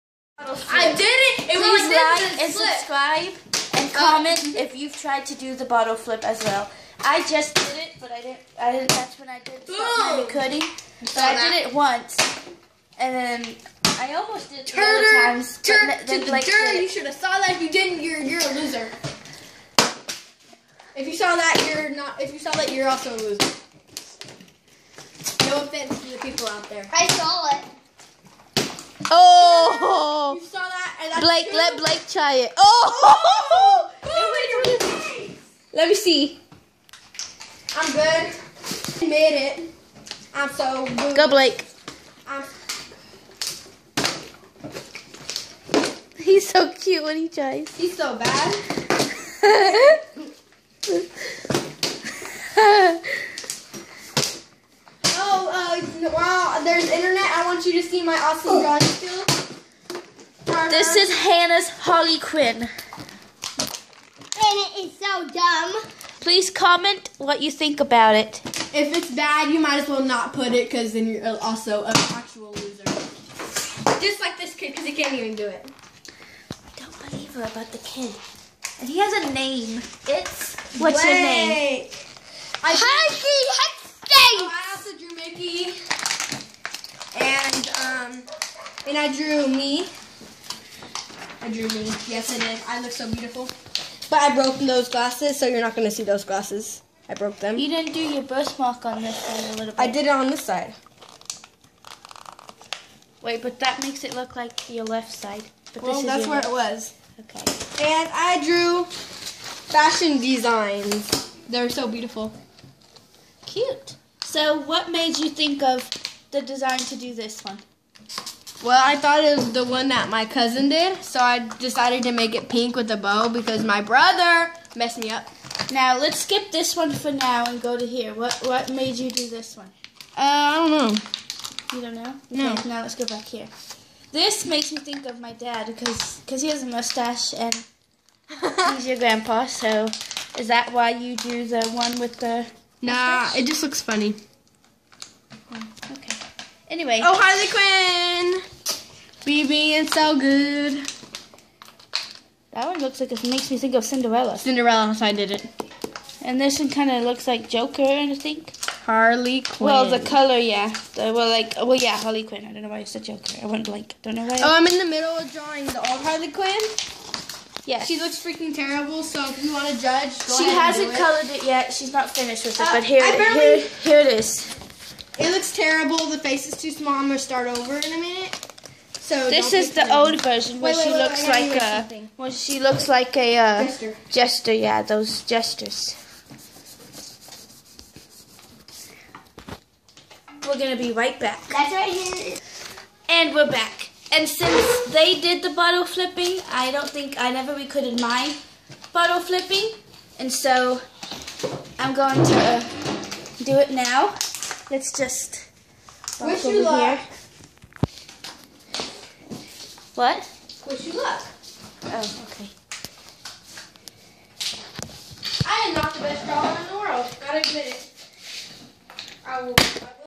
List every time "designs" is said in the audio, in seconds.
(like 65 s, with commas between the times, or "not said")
110 s, 116 s.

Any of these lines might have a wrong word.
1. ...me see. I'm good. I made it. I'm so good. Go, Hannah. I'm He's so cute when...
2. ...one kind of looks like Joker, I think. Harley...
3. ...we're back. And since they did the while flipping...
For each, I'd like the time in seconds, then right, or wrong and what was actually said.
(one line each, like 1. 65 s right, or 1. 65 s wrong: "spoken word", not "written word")
1. 35 s wrong: "Blake", not "Hannah"
2. 156 s right
3. 193 s wrong: "bottle", not "while".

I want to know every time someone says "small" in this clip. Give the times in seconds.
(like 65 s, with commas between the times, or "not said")
176 s.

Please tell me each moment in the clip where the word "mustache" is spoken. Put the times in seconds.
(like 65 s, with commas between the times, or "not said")
136 s, 142 s.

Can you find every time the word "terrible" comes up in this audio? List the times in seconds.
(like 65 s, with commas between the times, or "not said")
168 s, 175 s.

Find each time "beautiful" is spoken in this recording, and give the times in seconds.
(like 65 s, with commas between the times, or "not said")
93 s, 111 s.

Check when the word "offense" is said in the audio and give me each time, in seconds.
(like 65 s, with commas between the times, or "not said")
25 s.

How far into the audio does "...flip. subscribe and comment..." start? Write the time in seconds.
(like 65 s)
2 s.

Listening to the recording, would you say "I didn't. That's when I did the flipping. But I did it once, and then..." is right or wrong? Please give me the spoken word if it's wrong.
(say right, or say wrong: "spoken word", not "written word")
wrong: "cutting", not "flipping".